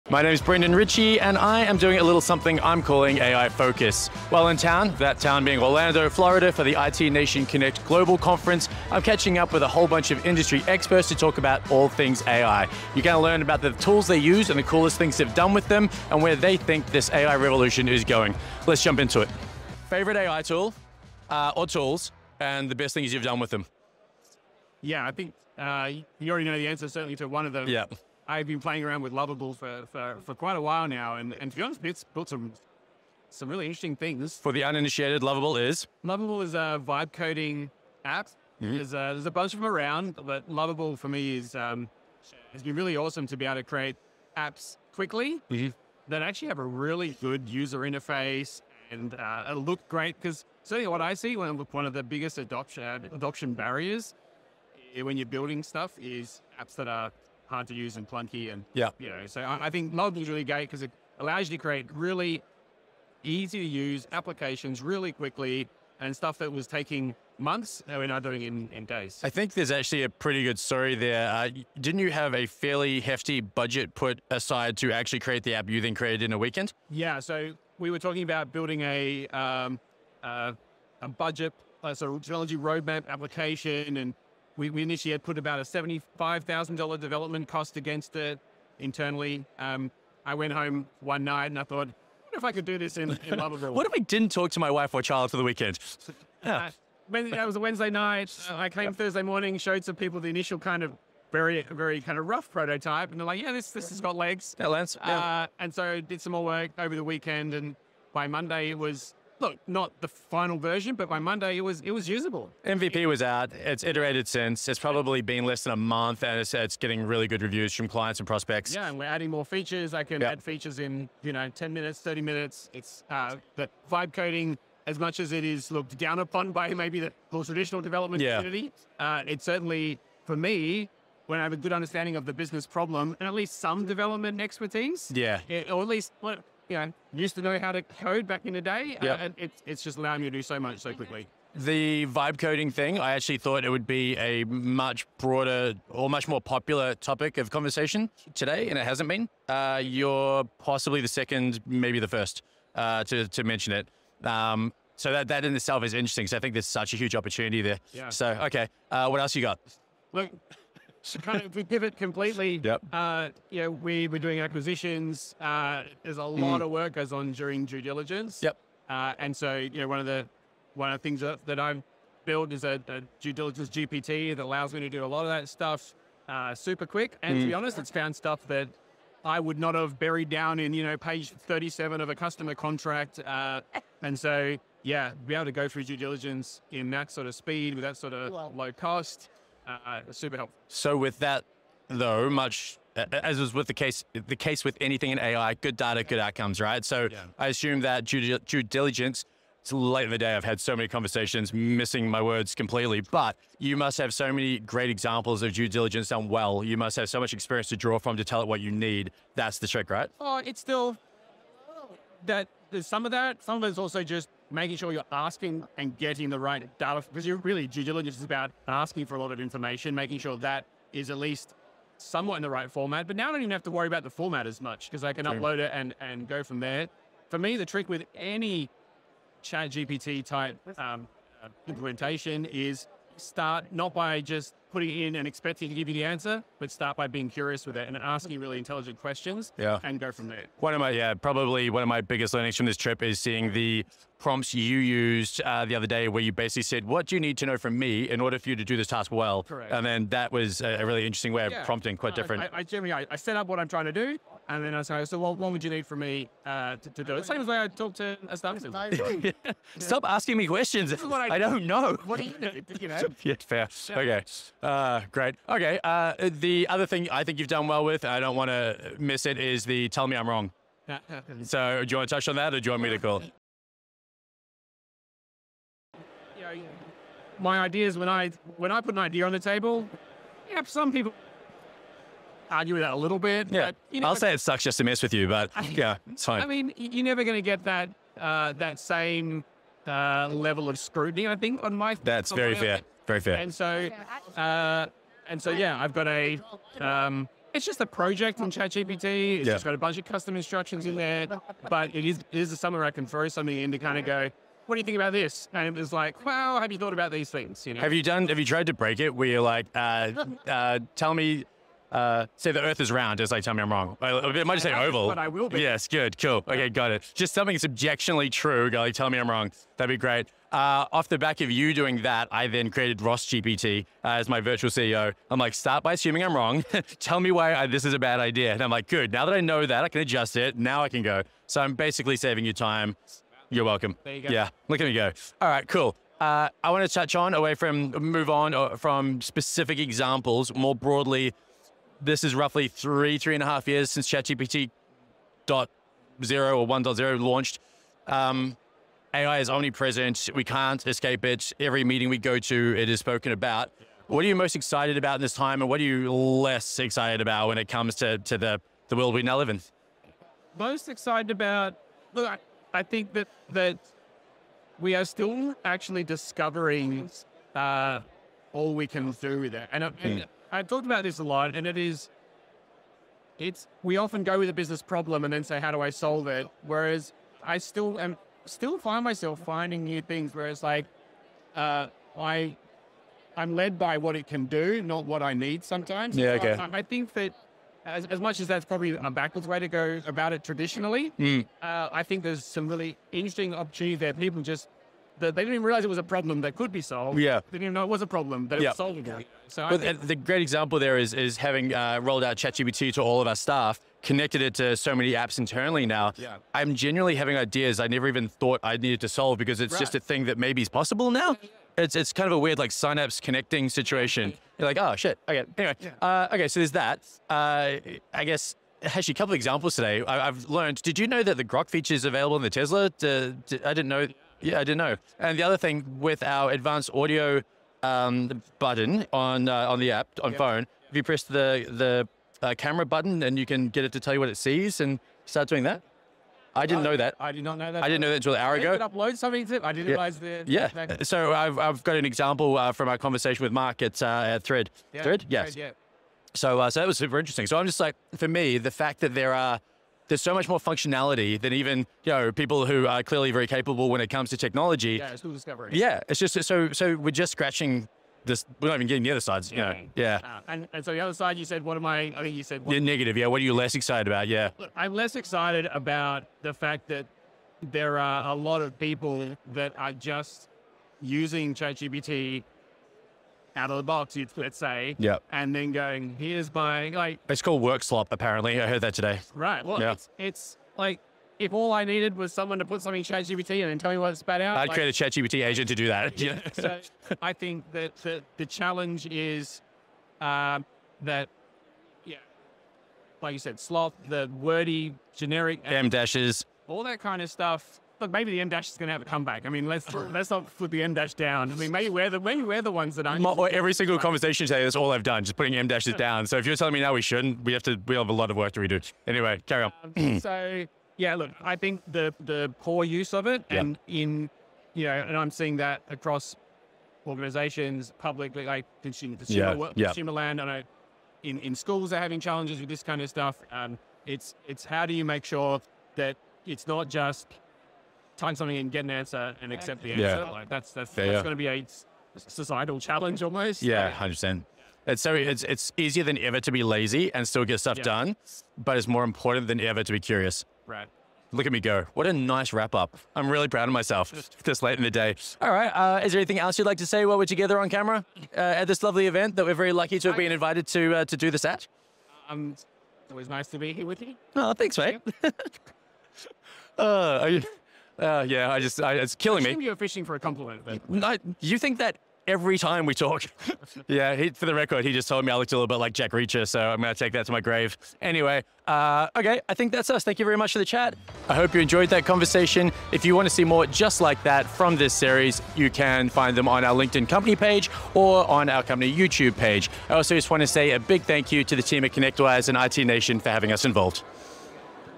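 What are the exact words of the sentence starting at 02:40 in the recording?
Look, so kind of we pivot completely.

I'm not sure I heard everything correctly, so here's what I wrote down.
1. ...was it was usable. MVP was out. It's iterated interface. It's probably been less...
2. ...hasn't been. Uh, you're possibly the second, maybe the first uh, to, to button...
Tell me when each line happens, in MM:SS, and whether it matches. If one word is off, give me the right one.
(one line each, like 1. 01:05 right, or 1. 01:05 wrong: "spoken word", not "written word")
1. 01:51 wrong: "since", not "interface"
2. 02:28 wrong: "mention", not "button".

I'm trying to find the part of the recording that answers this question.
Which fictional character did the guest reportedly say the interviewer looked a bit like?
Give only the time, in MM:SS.
09:25.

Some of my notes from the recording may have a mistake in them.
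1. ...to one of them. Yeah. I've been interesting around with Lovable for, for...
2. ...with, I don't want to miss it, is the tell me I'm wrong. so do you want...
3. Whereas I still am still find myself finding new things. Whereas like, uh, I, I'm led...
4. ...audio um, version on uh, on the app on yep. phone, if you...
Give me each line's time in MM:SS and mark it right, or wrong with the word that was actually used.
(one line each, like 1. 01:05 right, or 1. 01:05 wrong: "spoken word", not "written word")
1. 00:27 wrong: "playing", not "interesting"
2. 04:27 right
3. 06:16 right
4. 07:06 wrong: "button", not "version".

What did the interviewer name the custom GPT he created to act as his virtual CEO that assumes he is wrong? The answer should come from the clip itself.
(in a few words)
Ross GPT.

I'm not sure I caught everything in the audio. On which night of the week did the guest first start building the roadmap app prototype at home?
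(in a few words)
Wednesday.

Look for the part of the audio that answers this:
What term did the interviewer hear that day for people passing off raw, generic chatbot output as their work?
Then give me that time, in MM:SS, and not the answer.
07:57.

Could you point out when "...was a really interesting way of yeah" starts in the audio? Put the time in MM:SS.
04:10.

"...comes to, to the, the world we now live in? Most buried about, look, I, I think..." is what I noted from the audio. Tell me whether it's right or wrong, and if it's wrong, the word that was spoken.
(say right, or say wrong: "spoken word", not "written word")
wrong: "excited", not "buried".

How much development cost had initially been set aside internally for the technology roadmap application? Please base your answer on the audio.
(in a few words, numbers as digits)
$75,000.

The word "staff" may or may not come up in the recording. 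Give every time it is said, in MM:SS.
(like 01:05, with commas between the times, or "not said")
04:18, 06:43.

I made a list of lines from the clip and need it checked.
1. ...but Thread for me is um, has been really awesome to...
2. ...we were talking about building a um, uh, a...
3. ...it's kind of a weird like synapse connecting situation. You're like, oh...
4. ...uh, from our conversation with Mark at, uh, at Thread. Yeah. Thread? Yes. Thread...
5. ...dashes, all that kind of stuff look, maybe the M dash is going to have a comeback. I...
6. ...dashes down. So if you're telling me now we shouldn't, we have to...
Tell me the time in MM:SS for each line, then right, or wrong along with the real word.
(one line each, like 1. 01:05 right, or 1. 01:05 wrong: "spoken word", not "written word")
1. 00:40 wrong: "Lovable", not "Thread"
2. 01:17 right
3. 06:51 right
4. 07:22 right
5. 08:15 right
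6. 08:25 right.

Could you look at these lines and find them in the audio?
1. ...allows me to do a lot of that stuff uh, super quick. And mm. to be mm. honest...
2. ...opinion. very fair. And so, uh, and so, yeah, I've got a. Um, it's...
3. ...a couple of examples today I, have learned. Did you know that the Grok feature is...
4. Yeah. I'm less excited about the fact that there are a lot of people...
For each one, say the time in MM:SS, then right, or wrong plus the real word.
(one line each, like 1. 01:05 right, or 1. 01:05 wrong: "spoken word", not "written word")
1. 02:54 right
2. 04:52 right
3. 06:59 right
4. 07:44 right.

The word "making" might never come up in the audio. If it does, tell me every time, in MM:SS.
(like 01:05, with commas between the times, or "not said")
03:34, 03:39.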